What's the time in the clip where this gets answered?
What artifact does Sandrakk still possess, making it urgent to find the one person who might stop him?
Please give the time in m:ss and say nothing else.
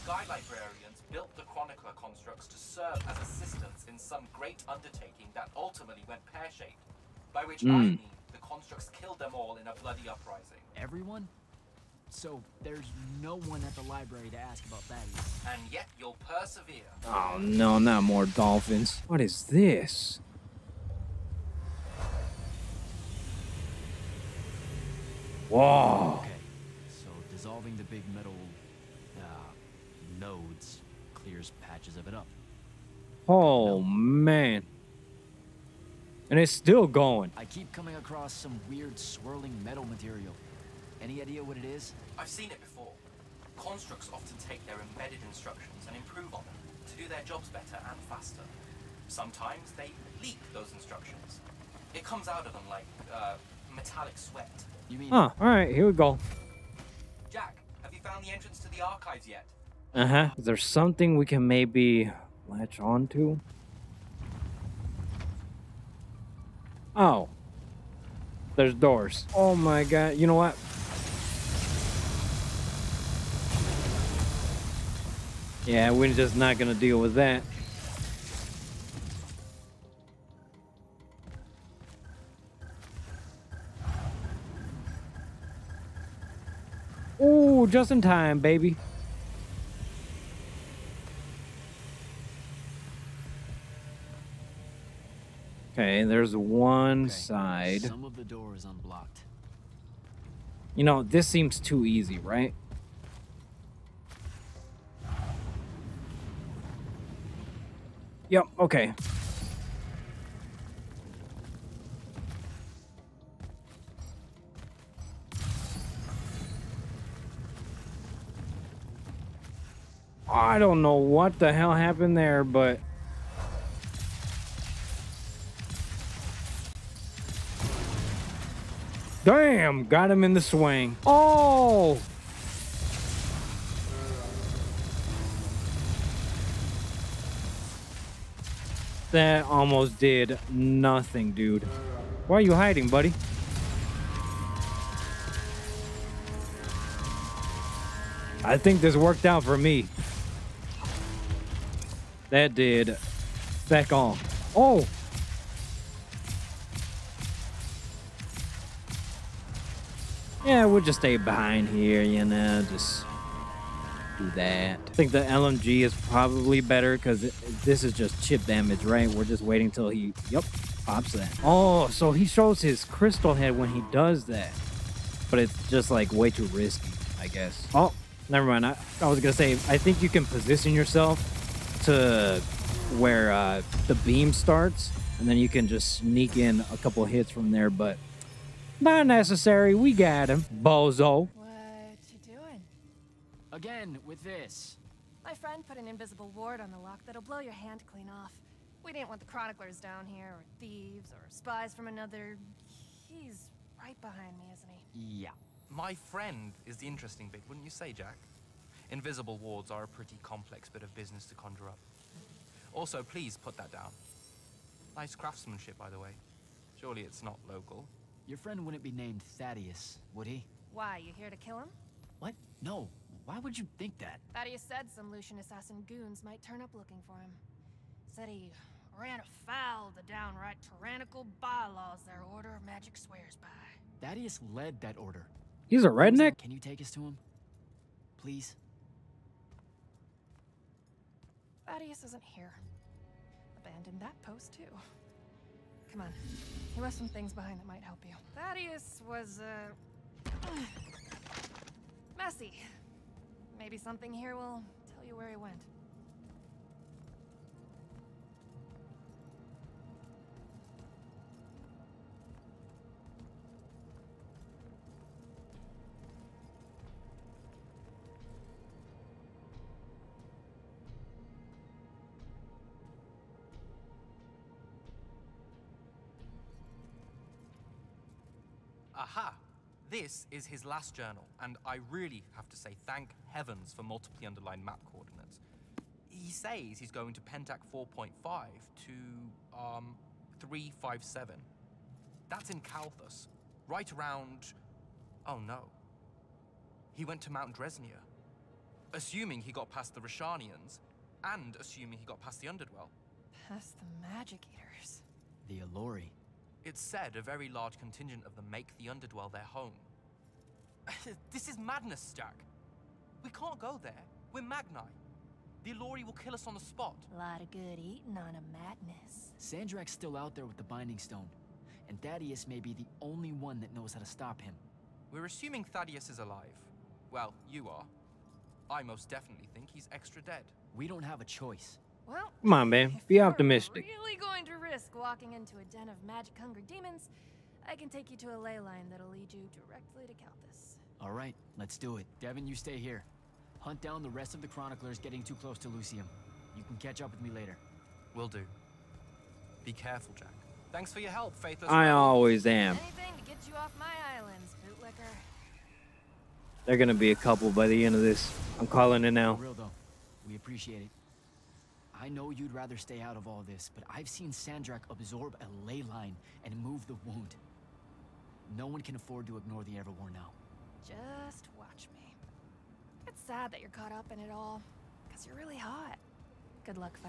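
5:20.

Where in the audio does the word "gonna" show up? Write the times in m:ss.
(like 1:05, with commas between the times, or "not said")
5:56.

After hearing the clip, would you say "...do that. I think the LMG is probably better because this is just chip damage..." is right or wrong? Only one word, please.
right.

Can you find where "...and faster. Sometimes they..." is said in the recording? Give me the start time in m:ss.
0:47.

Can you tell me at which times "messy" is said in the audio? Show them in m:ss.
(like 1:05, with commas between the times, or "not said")
4:12.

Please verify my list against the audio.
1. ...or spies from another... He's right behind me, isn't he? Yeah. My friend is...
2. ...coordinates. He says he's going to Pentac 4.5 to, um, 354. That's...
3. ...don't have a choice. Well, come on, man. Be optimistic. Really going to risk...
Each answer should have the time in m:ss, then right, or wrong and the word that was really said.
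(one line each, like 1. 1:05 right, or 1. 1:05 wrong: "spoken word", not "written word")
1. 3:21 right
2. 4:44 wrong: "357", not "354"
3. 5:30 right.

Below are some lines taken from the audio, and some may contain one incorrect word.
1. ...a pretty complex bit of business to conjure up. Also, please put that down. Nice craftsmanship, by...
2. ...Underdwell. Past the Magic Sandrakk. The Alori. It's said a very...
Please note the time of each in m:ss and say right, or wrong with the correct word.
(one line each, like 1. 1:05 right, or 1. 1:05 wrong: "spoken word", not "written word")
1. 3:29 right
2. 5:02 wrong: "Eaters", not "Sandrakk".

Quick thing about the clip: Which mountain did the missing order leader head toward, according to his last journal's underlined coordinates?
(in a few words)
Mount Dresnia.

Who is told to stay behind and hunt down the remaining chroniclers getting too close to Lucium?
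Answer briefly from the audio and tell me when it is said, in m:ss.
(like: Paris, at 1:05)
Devyn, at 5:42.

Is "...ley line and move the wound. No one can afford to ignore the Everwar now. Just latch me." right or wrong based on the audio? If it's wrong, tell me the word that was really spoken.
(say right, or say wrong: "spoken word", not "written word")
wrong: "watch", not "latch".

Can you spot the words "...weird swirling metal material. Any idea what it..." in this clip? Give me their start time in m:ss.
0:38.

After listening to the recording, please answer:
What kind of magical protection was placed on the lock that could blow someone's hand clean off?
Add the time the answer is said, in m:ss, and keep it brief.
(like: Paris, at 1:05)
invisible ward, at 3:15.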